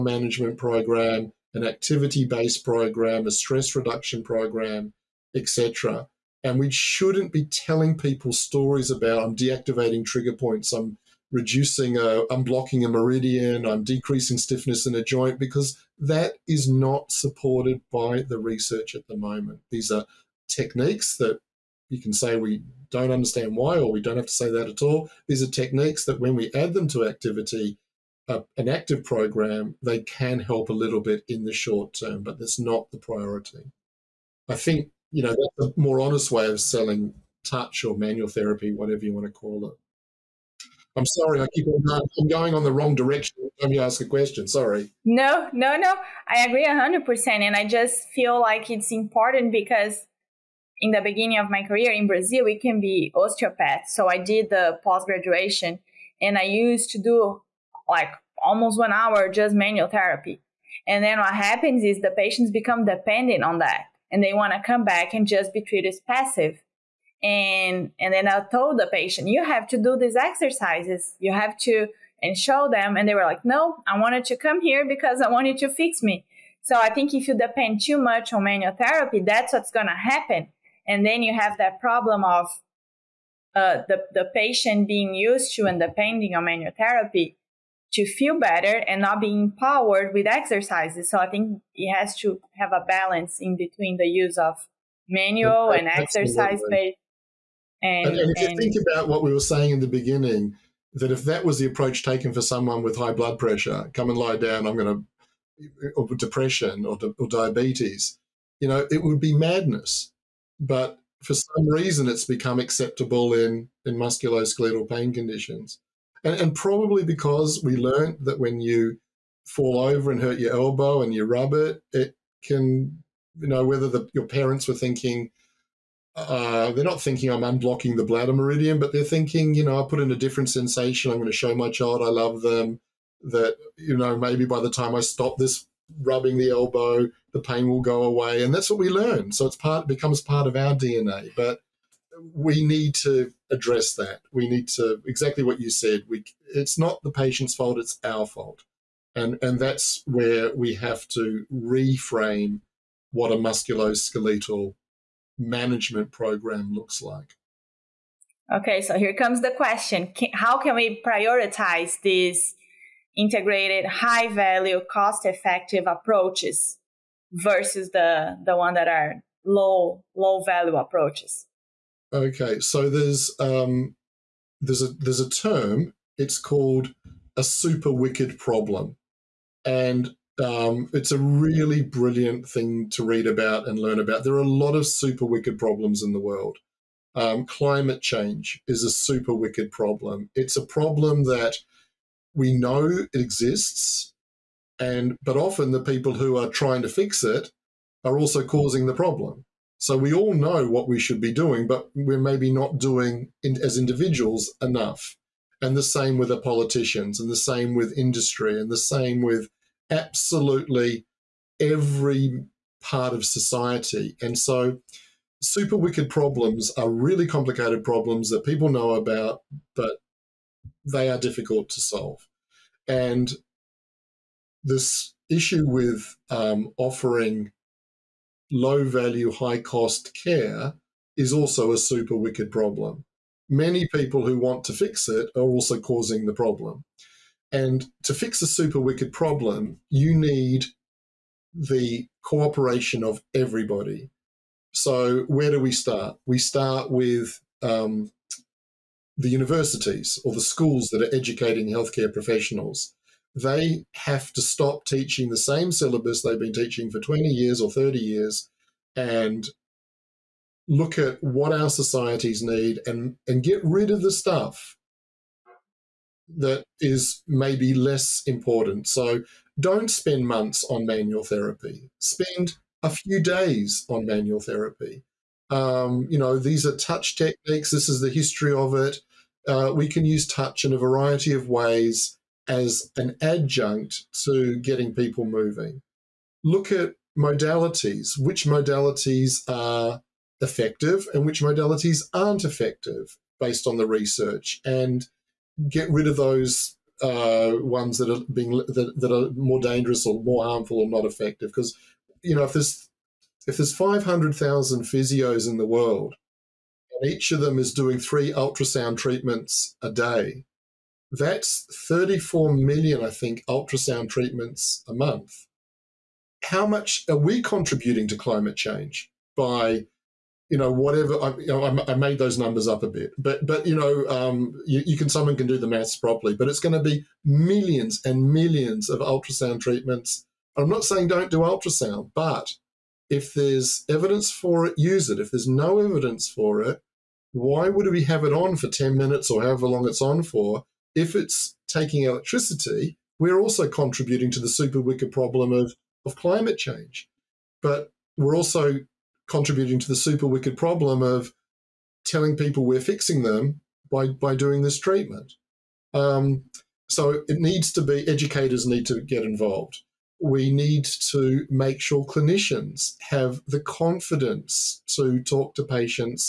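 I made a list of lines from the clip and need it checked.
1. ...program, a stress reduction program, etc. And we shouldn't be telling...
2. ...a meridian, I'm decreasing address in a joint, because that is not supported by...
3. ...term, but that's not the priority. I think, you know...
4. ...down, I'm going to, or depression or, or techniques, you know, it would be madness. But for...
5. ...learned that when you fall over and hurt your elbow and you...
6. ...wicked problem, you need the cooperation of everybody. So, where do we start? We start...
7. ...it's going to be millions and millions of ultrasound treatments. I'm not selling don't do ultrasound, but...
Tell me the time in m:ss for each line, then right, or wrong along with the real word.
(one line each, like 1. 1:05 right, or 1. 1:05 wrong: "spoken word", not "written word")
1. 0:02 right
2. 0:12 wrong: "stiffness", not "address"
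3. 0:31 right
4. 1:44 wrong: "diabetes", not "techniques"
5. 1:57 right
6. 3:58 right
7. 5:26 wrong: "saying", not "selling".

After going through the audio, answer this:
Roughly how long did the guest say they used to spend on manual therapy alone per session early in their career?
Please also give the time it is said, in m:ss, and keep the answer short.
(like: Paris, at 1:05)
almost one hour, at 0:58.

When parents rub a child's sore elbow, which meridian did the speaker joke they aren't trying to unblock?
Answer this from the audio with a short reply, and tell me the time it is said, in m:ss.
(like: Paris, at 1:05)
bladder meridian, at 2:08.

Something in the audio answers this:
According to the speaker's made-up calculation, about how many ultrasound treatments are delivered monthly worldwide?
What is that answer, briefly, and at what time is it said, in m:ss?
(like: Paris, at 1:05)
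34 million, at 5:11.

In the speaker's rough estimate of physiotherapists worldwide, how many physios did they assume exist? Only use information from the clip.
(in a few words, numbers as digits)
500,000.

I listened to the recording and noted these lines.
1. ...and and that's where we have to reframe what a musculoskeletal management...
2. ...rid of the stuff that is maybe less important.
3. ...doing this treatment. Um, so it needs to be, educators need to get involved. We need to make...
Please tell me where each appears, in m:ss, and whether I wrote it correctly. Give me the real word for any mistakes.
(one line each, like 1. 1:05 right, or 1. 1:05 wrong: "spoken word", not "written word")
1. 2:29 right
2. 4:23 right
3. 5:54 right.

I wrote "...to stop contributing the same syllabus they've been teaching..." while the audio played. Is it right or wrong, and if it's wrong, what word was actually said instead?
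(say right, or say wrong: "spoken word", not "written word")
wrong: "teaching", not "contributing".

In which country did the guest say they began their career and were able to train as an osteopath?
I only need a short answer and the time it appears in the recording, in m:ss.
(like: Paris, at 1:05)
Brazil, at 0:52.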